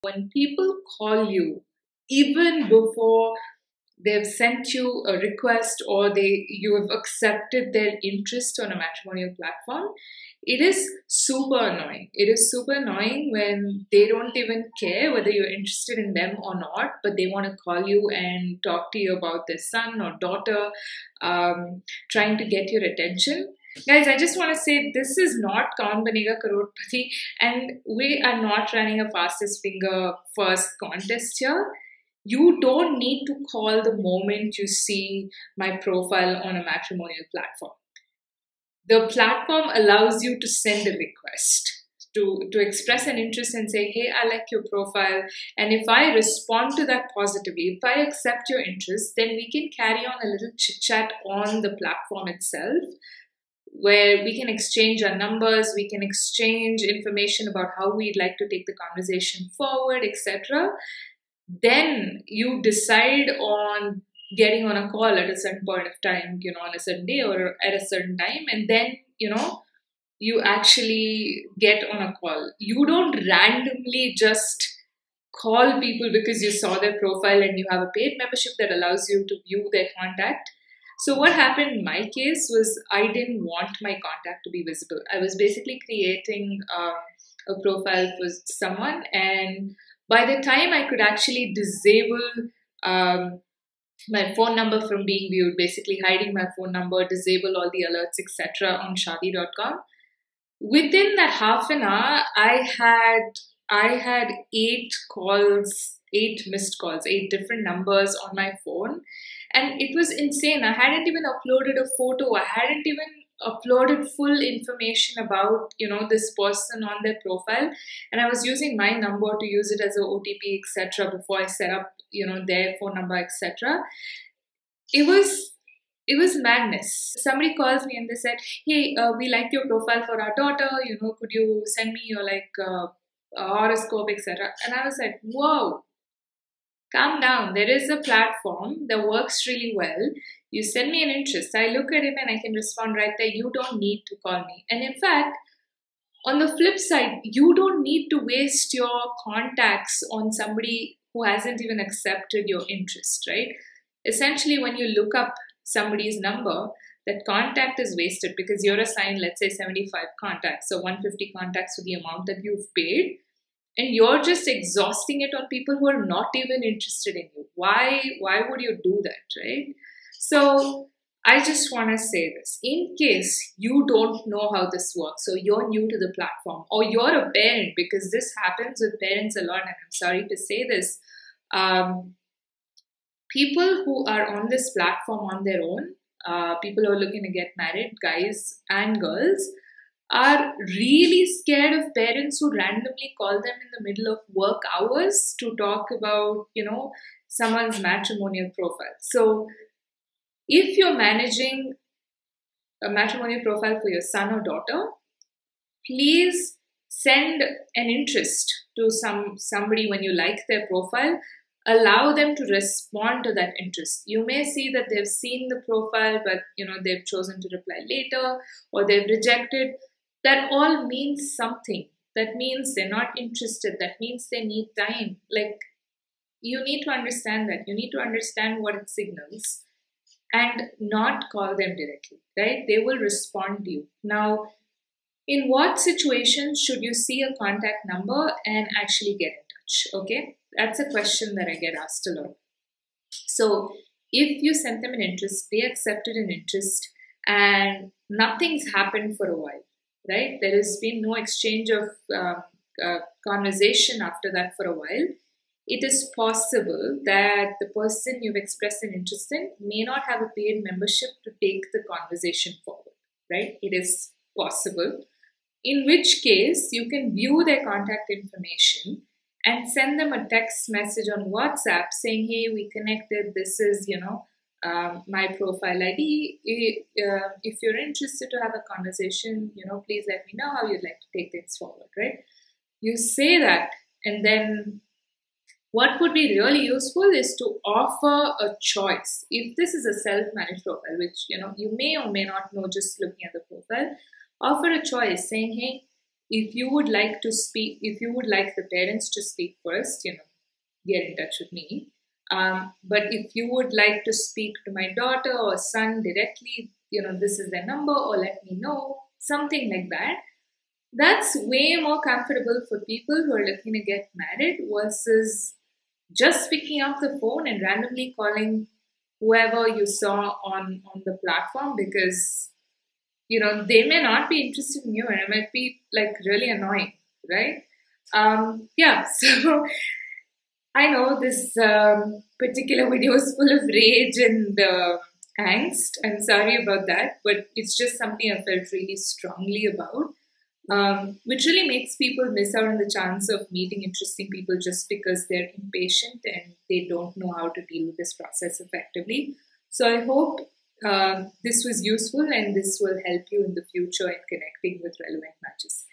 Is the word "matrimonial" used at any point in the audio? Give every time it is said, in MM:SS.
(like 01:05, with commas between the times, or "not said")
00:08, 00:36, 03:17, 03:22.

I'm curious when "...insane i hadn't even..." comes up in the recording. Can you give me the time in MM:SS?
01:50.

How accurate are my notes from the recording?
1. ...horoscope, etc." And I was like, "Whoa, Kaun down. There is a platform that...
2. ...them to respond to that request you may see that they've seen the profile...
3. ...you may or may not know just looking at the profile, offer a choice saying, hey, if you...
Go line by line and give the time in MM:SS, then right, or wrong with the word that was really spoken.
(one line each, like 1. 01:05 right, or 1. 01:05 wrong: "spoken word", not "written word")
1. 02:13 wrong: "Calm", not "Kaun"
2. 03:32 wrong: "interest", not "request"
3. 04:51 right.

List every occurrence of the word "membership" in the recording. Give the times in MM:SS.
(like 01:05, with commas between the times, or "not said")
01:18, 04:20.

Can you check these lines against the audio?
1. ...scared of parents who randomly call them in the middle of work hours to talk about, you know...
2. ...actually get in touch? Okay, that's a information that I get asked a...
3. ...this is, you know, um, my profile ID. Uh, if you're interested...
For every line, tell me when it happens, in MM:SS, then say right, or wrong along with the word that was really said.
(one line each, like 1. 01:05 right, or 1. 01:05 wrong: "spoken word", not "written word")
1. 03:11 right
2. 03:58 wrong: "question", not "information"
3. 04:33 right.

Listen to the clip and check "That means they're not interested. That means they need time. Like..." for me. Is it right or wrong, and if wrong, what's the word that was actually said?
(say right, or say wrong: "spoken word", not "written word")
right.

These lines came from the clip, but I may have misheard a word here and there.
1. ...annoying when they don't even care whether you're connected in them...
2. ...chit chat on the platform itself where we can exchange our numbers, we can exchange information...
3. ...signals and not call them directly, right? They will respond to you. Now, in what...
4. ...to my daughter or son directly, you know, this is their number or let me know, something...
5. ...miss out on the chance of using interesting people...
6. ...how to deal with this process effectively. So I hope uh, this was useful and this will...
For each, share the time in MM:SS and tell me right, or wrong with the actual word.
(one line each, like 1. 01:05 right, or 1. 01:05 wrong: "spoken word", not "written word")
1. 00:12 wrong: "interested", not "connected"
2. 00:50 right
3. 03:48 right
4. 05:04 right
5. 05:42 wrong: "meeting", not "using"
6. 05:47 right.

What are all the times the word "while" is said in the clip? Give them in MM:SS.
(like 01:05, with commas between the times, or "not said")
04:09, 04:14.